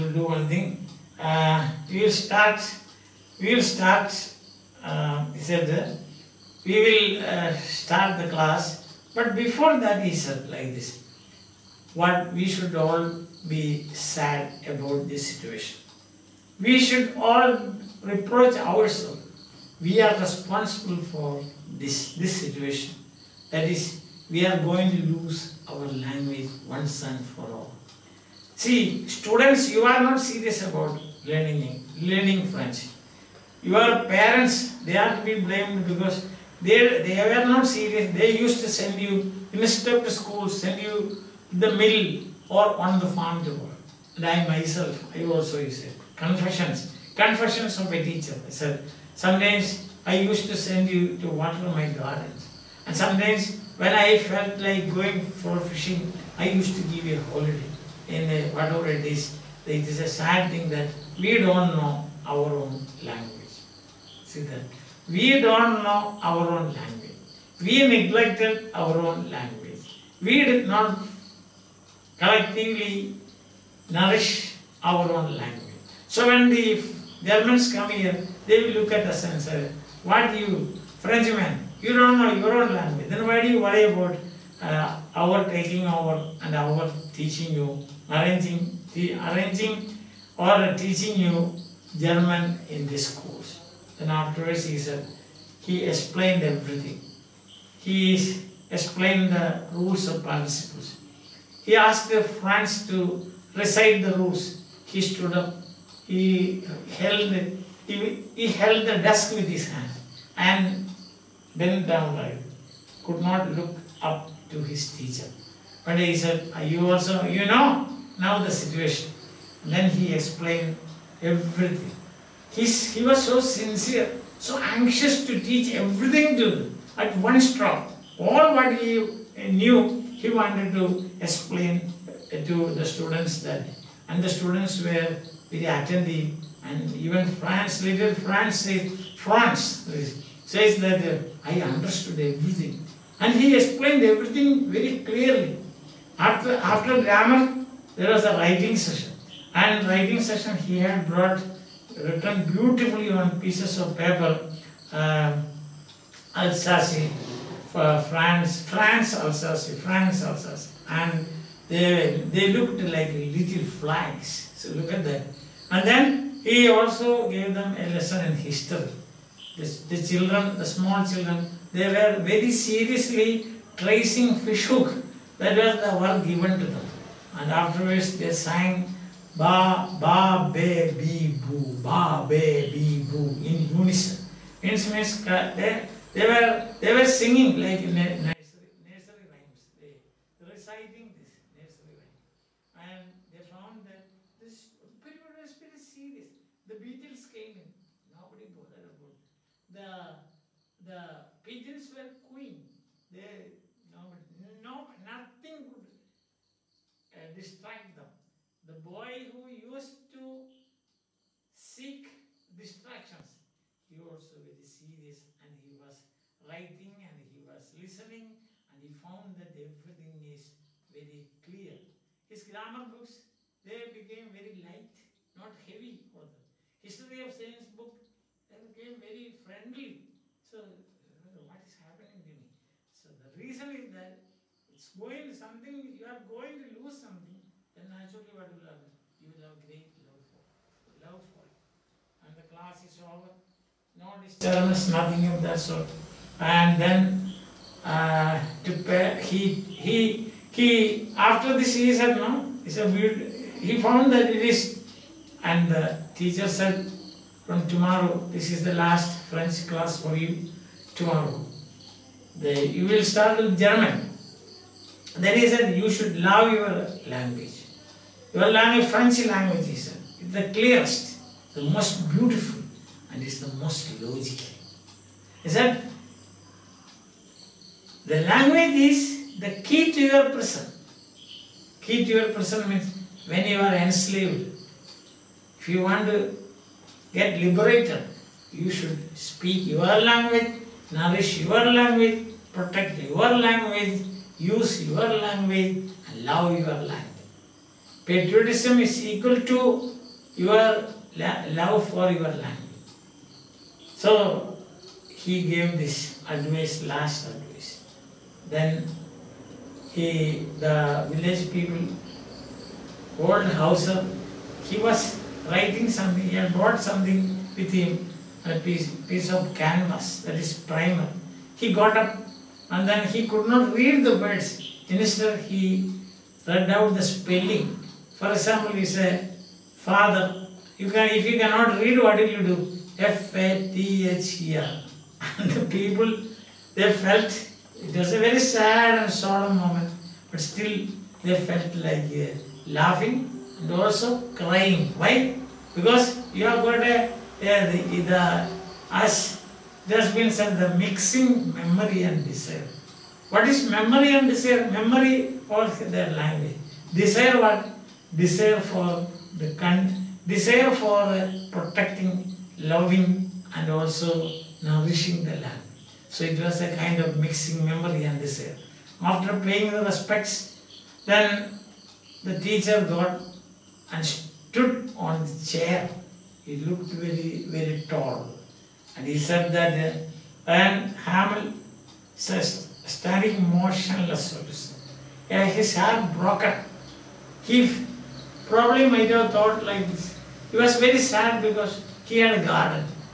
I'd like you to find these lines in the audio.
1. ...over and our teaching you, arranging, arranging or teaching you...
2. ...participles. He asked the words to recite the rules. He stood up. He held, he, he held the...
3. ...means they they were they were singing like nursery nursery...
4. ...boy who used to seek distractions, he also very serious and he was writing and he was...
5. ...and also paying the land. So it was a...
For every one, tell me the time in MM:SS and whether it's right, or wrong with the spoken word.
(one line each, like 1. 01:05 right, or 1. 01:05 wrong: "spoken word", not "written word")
1. 01:25 right
2. 01:40 wrong: "friends", not "words"
3. 03:04 right
4. 03:28 right
5. 06:03 wrong: "nourishing", not "paying".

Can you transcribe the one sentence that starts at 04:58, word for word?
Patriotism is equal to your love for your language.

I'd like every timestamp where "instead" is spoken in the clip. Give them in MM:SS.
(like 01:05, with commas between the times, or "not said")
00:39, 05:24.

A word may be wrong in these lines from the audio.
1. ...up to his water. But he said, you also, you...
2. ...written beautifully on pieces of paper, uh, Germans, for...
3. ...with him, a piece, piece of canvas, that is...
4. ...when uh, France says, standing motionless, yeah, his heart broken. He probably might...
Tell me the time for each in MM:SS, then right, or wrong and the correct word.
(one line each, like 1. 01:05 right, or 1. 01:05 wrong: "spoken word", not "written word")
1. 01:53 wrong: "teacher", not "water"
2. 02:31 wrong: "Alsace", not "Germans"
3. 05:17 right
4. 06:20 wrong: "Hamel", not "France".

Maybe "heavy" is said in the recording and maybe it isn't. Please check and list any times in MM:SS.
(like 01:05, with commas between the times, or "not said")
03:45.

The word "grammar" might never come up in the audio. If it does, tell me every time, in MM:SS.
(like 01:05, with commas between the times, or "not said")
02:27, 03:42.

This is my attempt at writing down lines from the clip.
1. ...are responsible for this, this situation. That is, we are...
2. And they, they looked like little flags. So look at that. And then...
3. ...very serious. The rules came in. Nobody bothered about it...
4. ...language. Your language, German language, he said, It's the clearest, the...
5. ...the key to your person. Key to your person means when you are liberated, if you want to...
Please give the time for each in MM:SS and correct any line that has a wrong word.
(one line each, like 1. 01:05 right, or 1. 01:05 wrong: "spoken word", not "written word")
1. 00:20 right
2. 02:40 right
3. 03:15 wrong: "beetles", not "rules"
4. 04:27 wrong: "French", not "German"
5. 04:39 wrong: "enslaved", not "liberated".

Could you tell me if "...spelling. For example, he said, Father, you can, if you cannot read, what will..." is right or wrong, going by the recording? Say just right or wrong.
right.